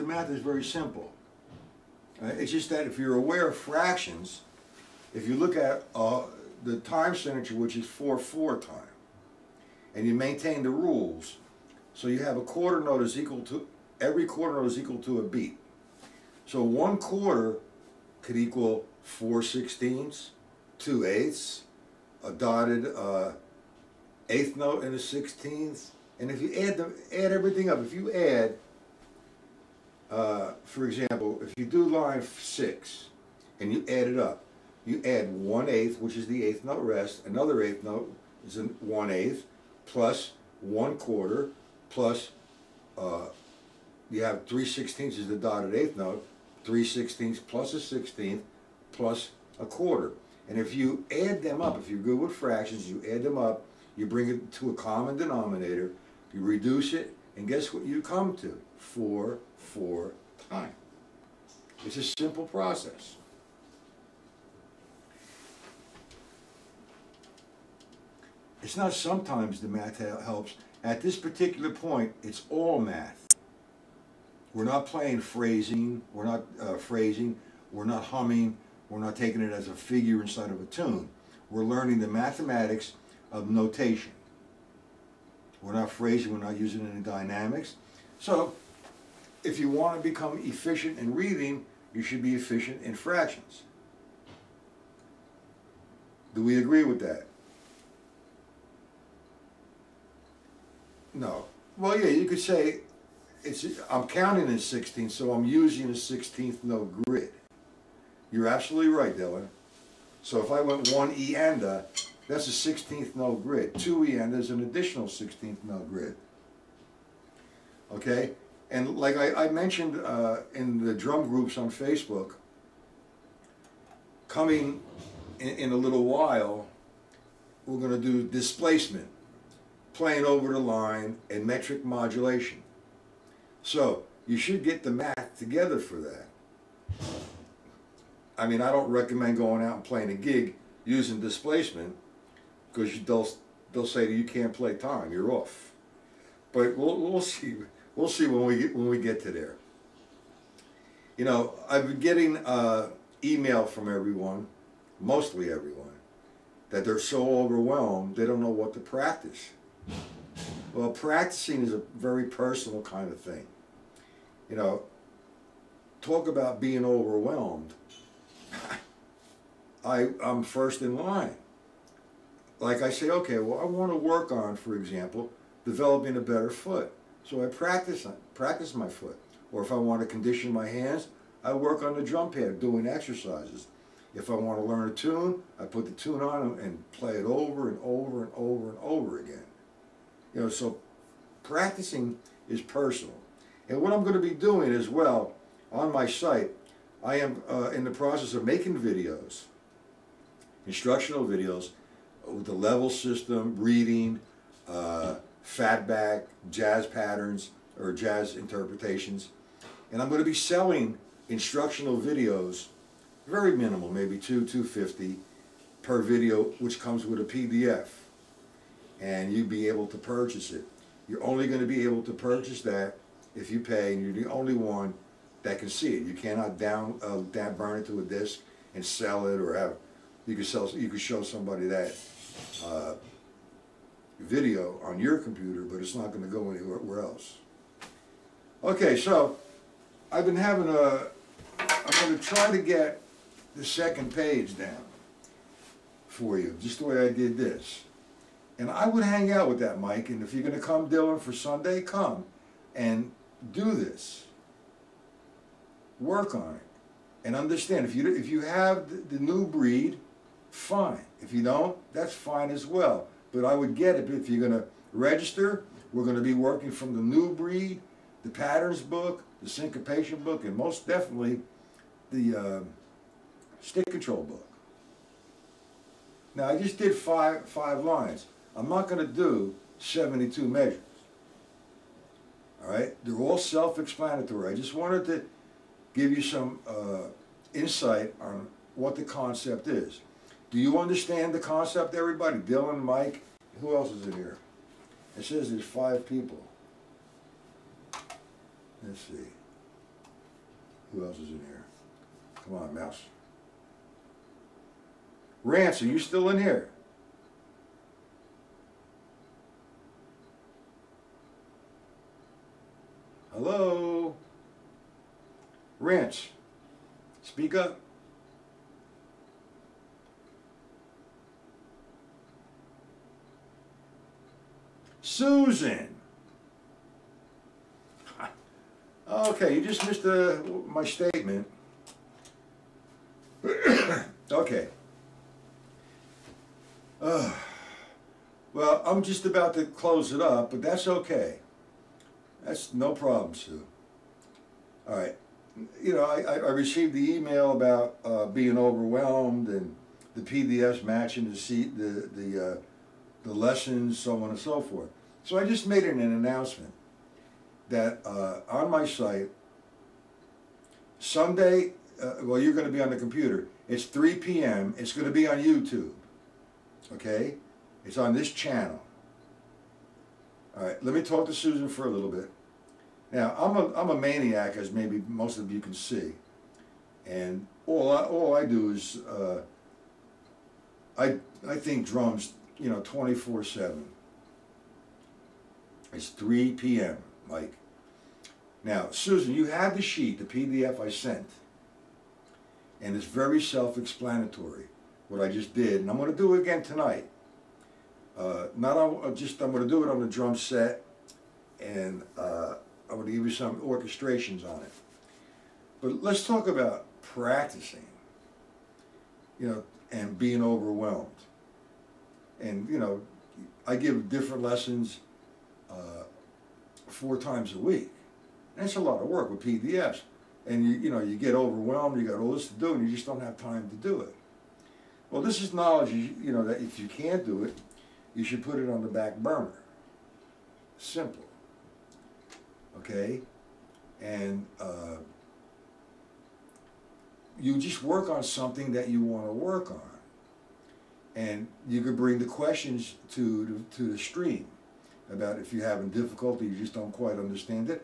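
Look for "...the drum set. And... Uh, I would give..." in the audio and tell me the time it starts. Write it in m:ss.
6:40.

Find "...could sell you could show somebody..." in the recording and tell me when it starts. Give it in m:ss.
3:50.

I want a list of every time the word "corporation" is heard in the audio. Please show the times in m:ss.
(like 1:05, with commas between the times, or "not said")
not said.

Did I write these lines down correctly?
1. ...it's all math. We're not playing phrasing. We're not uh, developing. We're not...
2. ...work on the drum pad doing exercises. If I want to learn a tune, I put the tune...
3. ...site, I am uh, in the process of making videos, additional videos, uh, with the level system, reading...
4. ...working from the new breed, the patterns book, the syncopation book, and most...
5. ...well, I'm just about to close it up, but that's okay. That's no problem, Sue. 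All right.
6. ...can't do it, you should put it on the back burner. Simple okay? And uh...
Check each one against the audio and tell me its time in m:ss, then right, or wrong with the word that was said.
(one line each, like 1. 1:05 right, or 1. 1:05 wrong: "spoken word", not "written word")
1. 1:12 wrong: "phrasing", not "developing"
2. 3:01 right
3. 3:16 wrong: "instructional", not "additional"
4. 4:26 right
5. 5:38 right
6. 7:06 right.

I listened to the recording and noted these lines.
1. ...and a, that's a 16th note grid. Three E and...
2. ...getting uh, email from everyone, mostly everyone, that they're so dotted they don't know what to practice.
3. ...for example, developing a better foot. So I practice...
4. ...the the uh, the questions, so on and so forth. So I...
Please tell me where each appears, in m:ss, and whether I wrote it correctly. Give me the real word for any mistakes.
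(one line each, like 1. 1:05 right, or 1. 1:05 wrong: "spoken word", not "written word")
1. 1:51 wrong: "Two", not "Three"
2. 2:32 wrong: "overwhelmed", not "dotted"
3. 2:54 right
4. 5:51 wrong: "lessons", not "questions".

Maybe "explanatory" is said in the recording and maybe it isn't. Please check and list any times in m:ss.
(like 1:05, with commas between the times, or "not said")
4:43, 6:33.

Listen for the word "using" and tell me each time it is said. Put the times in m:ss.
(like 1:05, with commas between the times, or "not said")
1:26, 1:45, 2:20.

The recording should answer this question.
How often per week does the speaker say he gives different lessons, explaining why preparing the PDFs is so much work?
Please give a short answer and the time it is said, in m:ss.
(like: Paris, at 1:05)
4 times a week, at 6:56.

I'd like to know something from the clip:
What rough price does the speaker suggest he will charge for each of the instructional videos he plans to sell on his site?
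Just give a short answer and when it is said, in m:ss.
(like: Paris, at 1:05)
250, at 3:34.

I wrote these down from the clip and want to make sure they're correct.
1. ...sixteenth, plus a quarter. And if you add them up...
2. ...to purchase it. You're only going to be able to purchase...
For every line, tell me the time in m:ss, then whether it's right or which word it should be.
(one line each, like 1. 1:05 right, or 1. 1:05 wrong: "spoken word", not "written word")
1. 0:47 right
2. 3:39 right.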